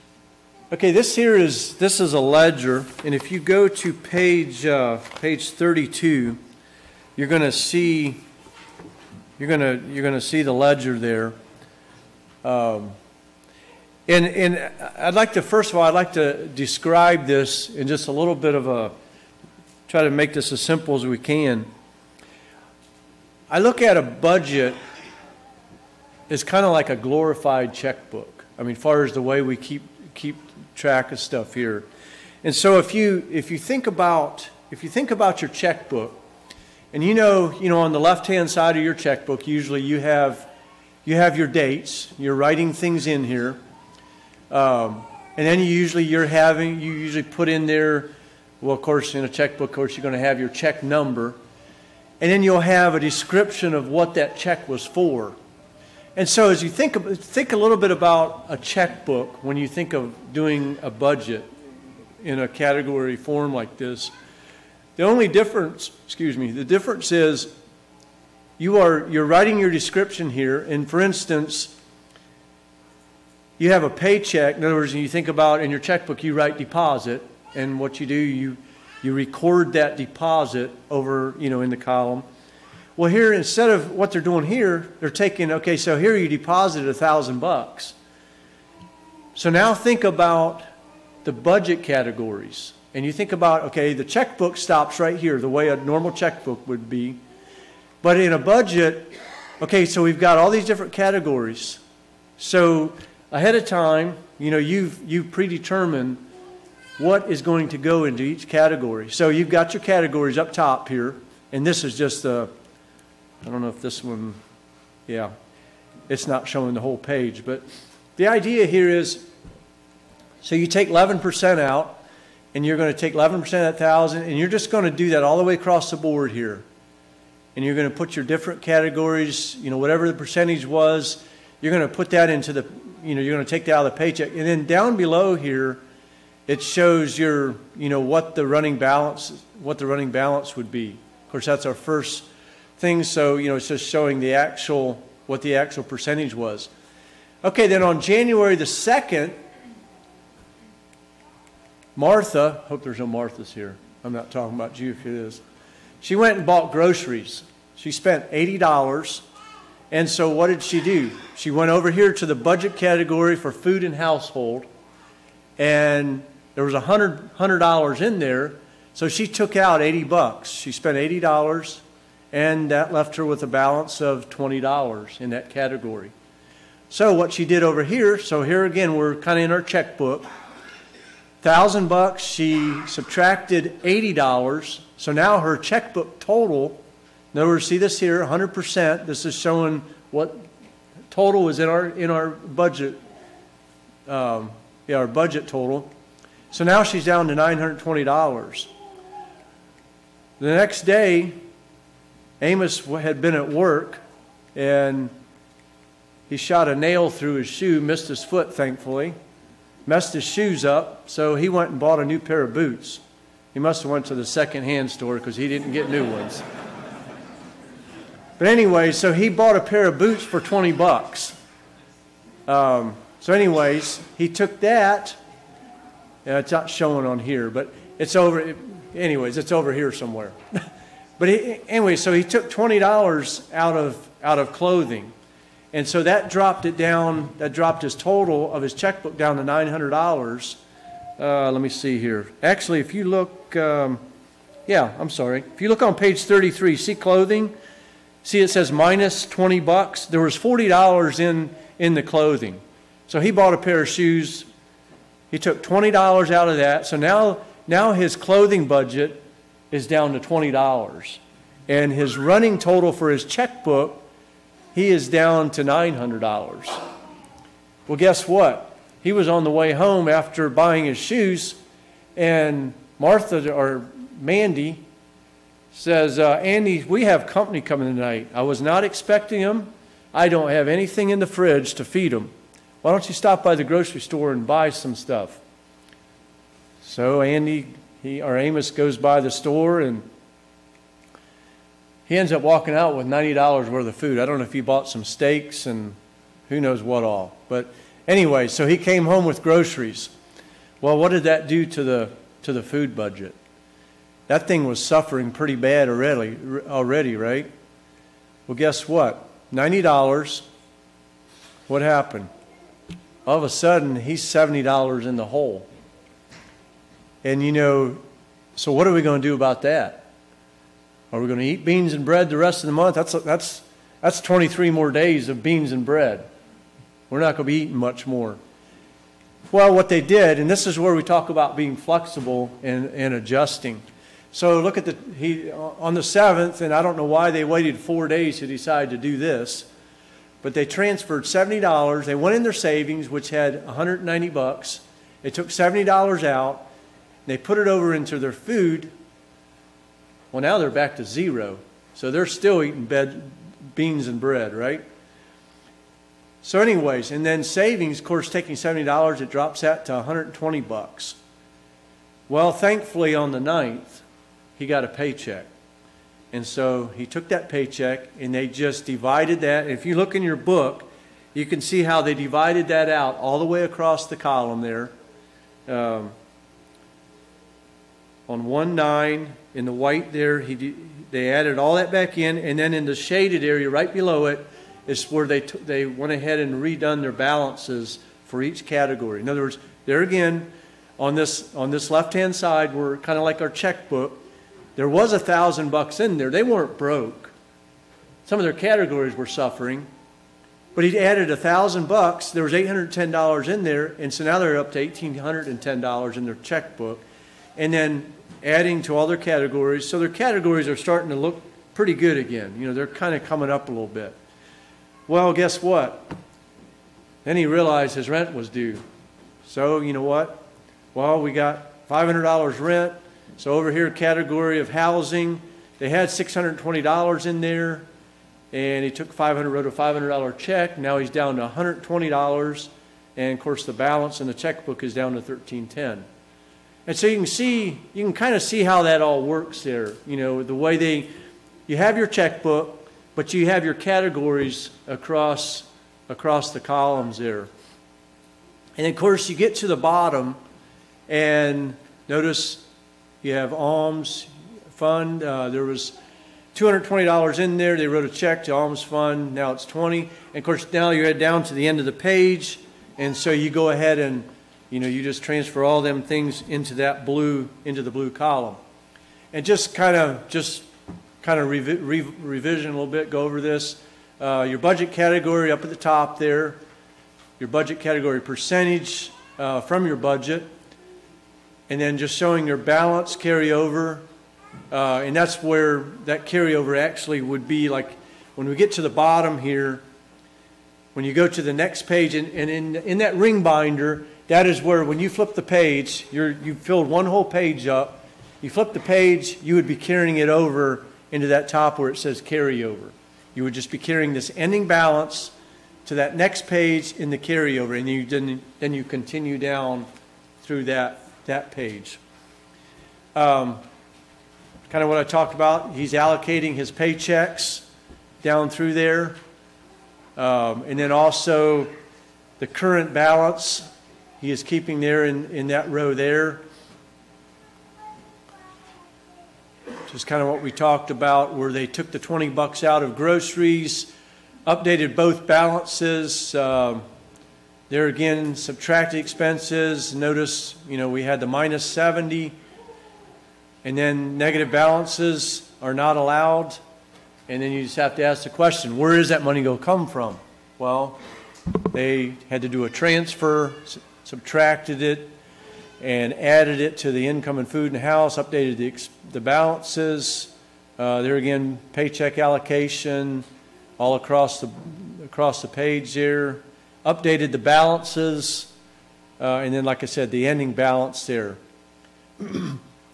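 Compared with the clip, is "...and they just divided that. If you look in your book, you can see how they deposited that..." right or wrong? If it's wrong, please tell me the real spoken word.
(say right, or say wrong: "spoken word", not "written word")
wrong: "divided", not "deposited".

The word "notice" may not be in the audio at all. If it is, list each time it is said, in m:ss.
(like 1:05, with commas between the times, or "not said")
7:32, 8:59.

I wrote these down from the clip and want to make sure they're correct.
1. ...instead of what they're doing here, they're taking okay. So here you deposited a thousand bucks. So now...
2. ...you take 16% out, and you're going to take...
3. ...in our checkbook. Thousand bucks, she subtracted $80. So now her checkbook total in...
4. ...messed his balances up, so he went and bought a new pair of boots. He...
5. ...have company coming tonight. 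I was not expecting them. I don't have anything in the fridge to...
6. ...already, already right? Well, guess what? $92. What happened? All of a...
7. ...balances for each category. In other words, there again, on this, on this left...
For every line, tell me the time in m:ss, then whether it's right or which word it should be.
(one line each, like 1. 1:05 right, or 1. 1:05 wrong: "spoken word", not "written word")
1. 1:23 right
2. 2:00 wrong: "11", not "16"
3. 2:59 right
4. 3:29 wrong: "shoes", not "balances"
5. 4:37 right
6. 5:05 wrong: "90", not "92"
7. 6:27 right.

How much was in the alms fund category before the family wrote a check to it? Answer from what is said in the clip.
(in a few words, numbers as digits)
$220.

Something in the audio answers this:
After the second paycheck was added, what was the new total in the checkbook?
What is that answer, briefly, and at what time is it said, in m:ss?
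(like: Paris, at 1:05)
$1,810, at 6:44.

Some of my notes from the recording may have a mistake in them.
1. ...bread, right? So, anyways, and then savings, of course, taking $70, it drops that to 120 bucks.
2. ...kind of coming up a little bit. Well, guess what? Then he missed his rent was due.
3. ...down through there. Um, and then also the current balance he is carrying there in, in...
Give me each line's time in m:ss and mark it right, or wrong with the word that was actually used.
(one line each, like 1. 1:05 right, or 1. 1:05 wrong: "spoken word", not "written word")
1. 5:54 right
2. 6:52 wrong: "realized", not "missed"
3. 8:38 wrong: "keeping", not "carrying".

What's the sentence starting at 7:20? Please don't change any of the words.
You know, the way they, you have your checkbook, but you have your categories across across the columns there.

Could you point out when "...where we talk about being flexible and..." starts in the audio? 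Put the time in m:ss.
5:30.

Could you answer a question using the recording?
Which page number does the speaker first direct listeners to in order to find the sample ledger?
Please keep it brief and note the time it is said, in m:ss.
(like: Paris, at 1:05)
32, at 0:05.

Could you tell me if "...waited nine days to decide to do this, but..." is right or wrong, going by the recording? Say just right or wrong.
wrong.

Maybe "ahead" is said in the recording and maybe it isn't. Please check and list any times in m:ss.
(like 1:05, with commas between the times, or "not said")
1:43, 6:26, 7:43.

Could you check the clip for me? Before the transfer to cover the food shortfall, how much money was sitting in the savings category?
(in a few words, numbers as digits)
$190.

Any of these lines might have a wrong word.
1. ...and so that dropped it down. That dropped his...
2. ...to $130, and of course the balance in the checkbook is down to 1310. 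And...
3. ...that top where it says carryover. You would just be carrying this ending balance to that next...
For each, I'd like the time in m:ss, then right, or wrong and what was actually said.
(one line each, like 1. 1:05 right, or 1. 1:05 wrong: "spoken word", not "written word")
1. 3:55 right
2. 7:11 wrong: "120", not "130"
3. 8:21 right.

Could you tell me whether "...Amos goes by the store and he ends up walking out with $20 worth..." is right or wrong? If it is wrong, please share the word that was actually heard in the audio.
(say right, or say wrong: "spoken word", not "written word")
wrong: "90", not "20".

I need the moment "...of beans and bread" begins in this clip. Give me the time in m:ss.
5:25.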